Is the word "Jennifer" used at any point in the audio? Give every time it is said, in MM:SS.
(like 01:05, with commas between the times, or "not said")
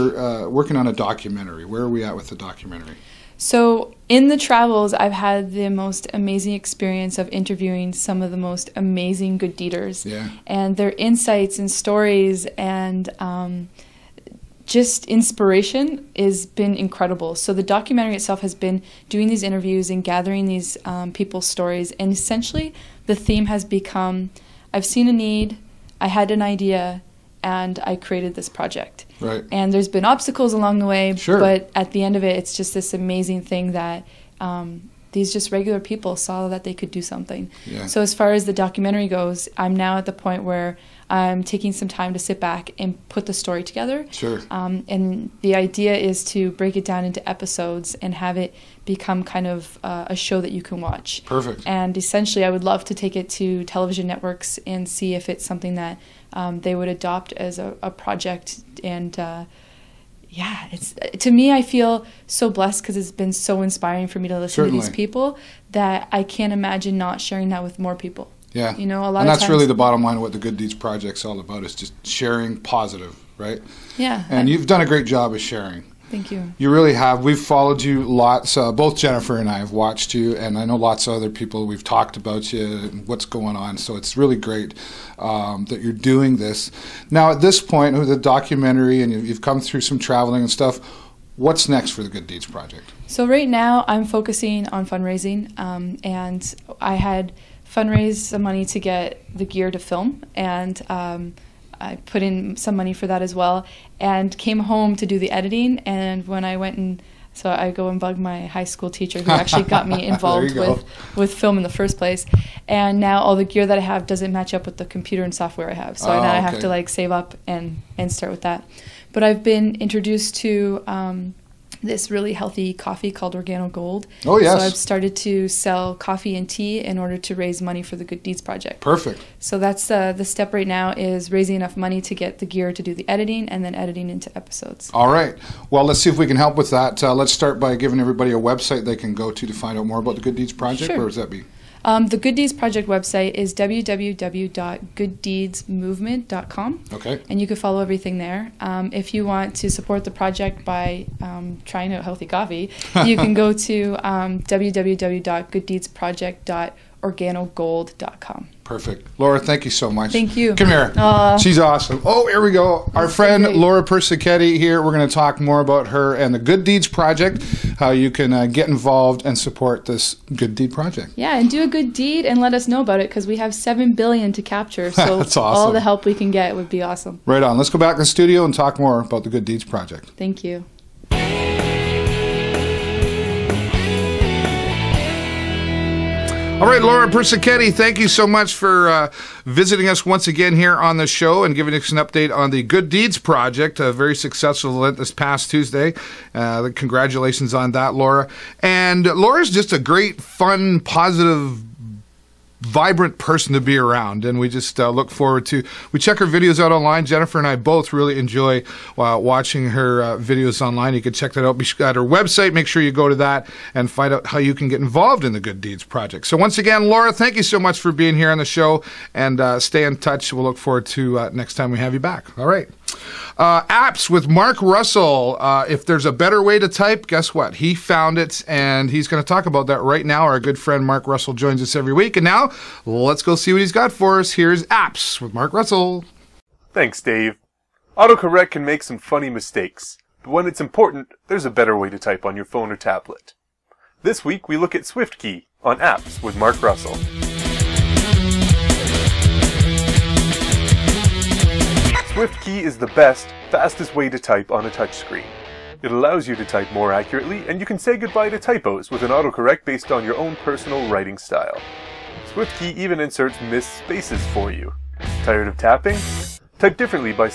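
01:18, 03:27.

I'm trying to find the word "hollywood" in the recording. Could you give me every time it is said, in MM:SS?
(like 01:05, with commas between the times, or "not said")
not said.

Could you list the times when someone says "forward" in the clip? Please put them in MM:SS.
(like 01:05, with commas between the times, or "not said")
03:25, 03:40.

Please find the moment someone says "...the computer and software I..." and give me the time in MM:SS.
01:54.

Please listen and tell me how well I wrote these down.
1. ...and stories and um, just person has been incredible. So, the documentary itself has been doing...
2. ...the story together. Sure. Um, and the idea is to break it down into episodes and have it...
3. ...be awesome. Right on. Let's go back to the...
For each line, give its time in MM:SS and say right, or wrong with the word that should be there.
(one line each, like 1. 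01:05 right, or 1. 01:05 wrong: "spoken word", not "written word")
1. 00:11 wrong: "inspiration", not "person"
2. 00:43 right
3. 02:56 right.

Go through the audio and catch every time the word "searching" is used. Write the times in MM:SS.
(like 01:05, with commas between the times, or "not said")
not said.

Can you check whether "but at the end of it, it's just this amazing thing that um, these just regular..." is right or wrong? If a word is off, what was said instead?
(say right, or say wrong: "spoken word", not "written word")
right.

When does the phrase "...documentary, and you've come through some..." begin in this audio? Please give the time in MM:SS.
01:28.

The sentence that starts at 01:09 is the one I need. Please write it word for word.
And that's times, really the bottom line.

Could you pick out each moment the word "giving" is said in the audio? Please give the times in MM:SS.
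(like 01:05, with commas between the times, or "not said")
02:17, 03:11.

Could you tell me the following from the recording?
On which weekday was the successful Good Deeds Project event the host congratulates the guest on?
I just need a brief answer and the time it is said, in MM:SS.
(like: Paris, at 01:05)
Tuesday, at 03:15.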